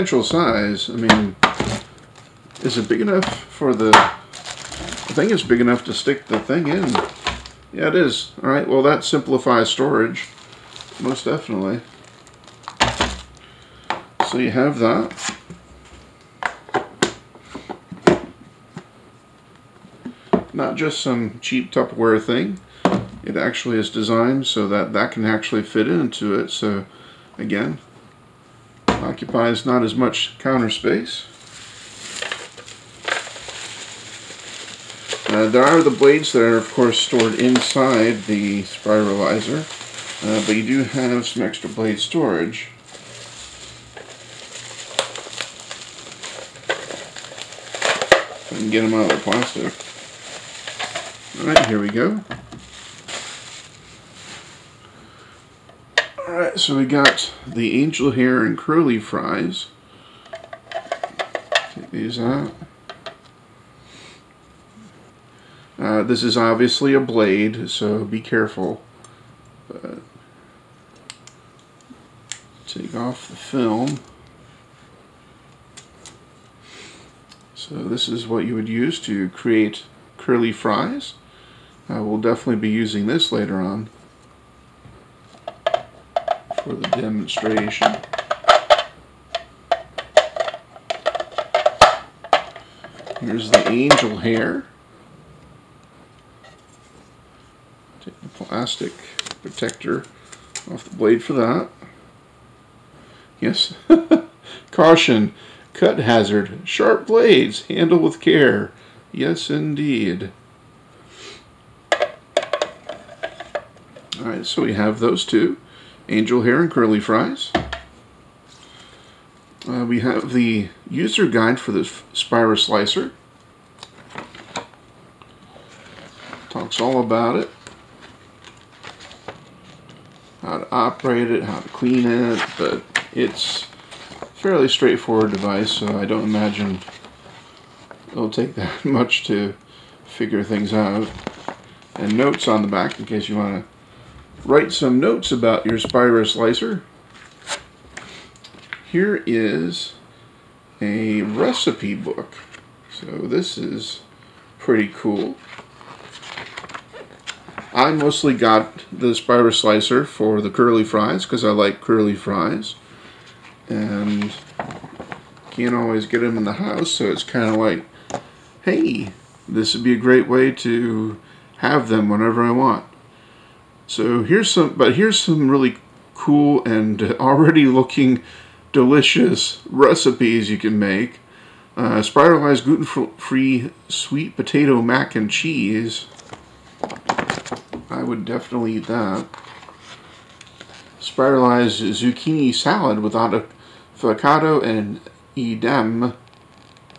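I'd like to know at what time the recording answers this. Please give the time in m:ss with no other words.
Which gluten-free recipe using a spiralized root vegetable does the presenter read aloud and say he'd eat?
3:03.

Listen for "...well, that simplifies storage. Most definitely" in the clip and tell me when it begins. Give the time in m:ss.
0:08.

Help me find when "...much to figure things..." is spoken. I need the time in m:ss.
2:18.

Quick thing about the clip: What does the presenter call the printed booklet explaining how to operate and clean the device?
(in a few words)
User guide.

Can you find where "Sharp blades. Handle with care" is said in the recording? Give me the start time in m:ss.
1:46.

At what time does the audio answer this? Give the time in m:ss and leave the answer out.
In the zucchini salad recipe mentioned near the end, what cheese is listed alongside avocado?
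3:15.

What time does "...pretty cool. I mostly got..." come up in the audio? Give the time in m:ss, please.
2:34.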